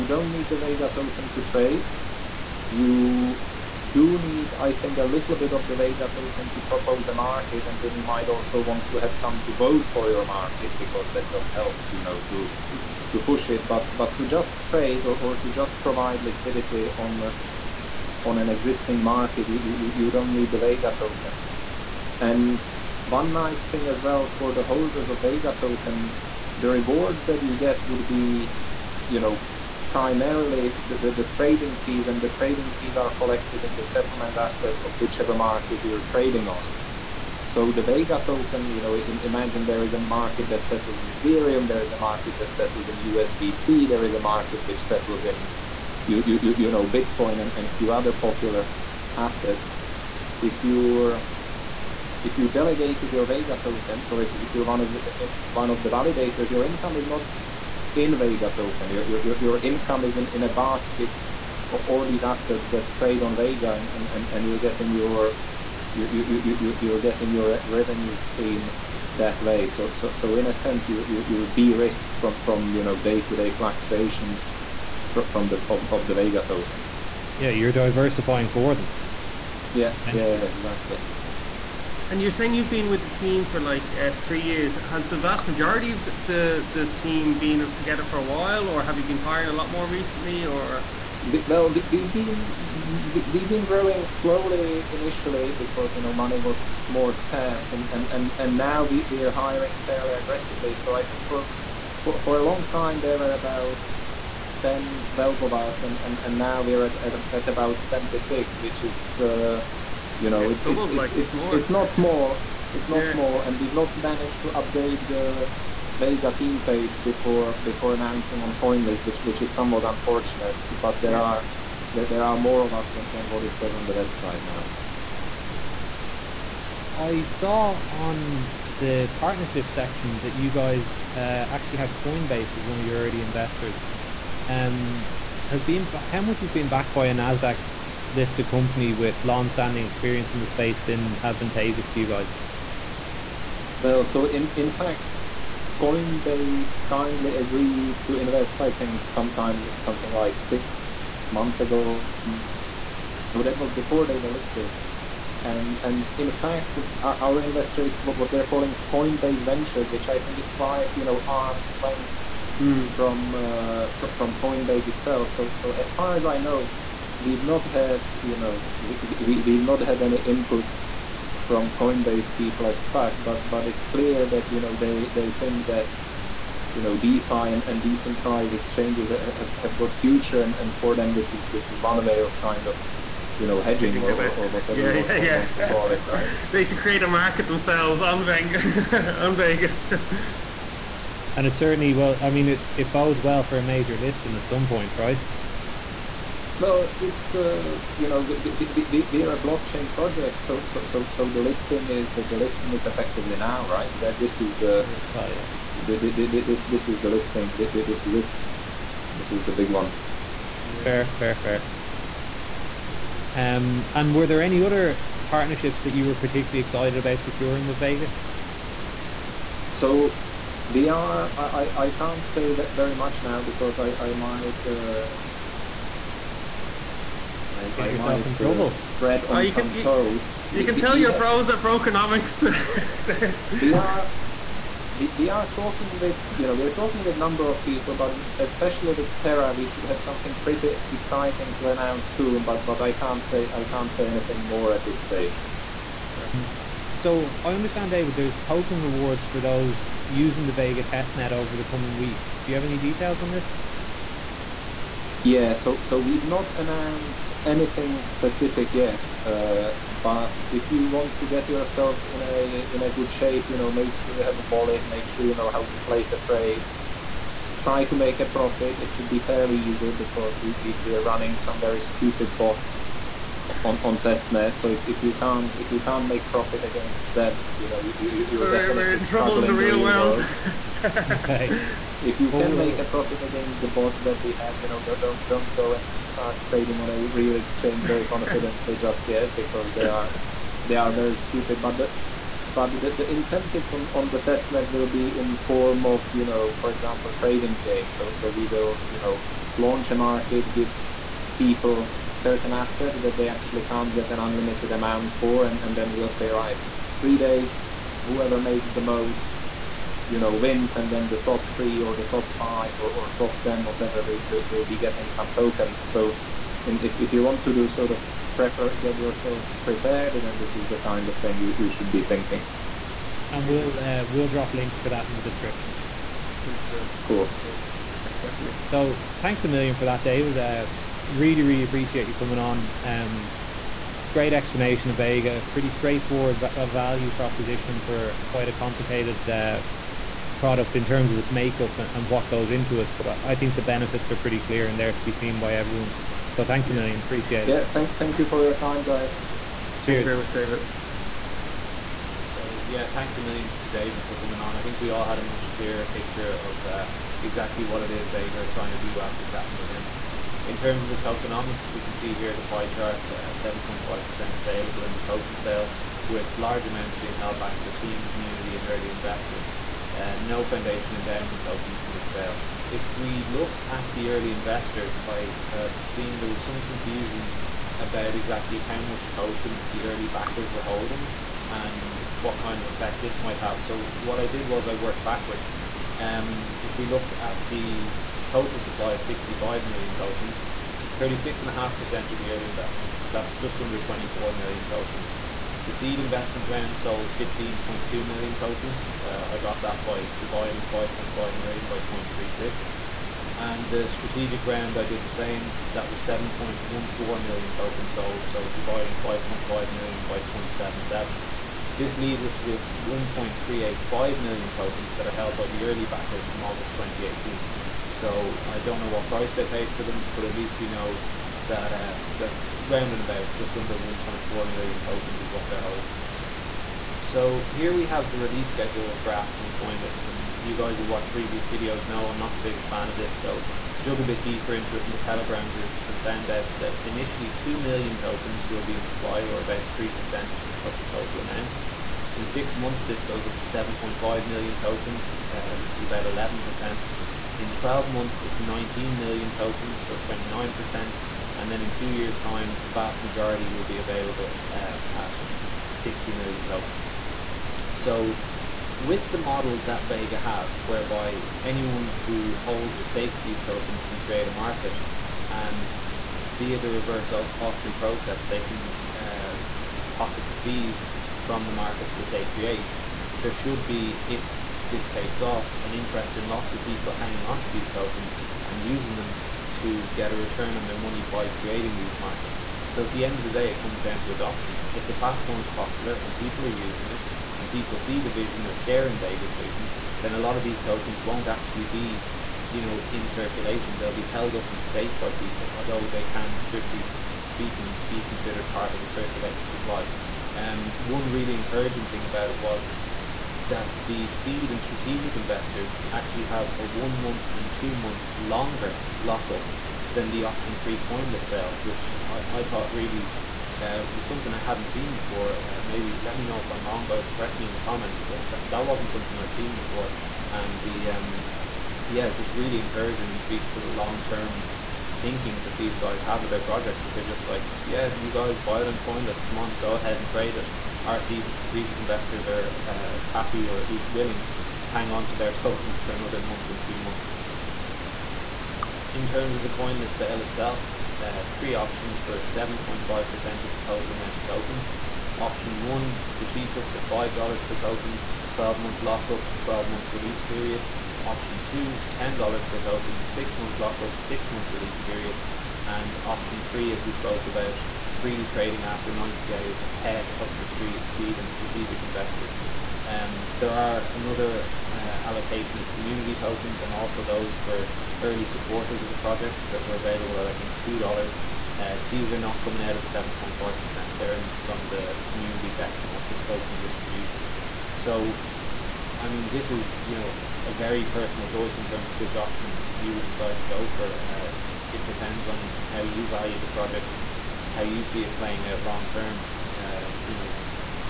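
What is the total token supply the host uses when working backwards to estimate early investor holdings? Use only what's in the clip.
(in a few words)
65 million.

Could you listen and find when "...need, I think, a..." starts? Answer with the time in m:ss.
0:04.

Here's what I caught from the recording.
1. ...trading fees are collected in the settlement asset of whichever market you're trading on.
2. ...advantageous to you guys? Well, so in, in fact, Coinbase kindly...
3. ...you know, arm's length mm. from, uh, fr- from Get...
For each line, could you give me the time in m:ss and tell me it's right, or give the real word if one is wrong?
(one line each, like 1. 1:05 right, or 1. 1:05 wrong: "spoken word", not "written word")
1. 0:32 right
2. 2:21 right
3. 2:40 wrong: "Coinbase", not "Get".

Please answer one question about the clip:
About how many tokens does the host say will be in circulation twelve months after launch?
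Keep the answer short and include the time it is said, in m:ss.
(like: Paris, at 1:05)
19 million, at 7:28.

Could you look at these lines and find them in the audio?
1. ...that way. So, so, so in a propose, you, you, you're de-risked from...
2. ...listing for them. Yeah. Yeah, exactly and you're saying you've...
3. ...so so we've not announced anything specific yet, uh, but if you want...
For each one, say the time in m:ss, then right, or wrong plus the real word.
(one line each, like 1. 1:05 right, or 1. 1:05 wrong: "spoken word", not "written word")
1. 1:09 wrong: "sense", not "propose"
2. 1:17 wrong: "diversifying", not "listing"
3. 4:15 right.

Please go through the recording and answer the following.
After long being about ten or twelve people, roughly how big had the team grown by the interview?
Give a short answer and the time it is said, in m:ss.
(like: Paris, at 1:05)
26, at 1:47.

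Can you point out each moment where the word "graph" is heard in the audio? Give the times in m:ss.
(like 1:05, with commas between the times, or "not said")
7:09.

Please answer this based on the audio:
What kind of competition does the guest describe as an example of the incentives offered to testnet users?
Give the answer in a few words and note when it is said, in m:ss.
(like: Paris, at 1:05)
trading game, at 4:57.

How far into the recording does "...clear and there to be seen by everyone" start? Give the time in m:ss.
5:44.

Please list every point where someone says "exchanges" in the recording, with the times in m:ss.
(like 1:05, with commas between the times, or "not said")
2:58, 4:47.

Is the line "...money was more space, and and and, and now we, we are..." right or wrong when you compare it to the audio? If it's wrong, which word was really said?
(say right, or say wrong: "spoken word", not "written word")
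wrong: "scarce", not "space".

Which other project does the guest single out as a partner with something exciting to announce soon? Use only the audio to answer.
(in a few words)
Terra.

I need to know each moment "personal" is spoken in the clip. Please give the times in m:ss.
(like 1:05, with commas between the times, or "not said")
9:40.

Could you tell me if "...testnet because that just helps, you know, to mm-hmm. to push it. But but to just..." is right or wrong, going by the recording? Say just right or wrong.
wrong.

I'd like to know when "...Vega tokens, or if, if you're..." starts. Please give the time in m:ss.
0:53.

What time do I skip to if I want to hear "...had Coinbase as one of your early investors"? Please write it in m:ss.
2:11.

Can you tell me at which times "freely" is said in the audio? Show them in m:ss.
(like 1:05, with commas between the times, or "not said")
9:17.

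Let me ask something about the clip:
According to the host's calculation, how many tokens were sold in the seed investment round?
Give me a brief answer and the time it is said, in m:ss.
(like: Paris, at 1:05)
15.2 million, at 6:37.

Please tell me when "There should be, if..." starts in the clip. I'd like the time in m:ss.
7:53.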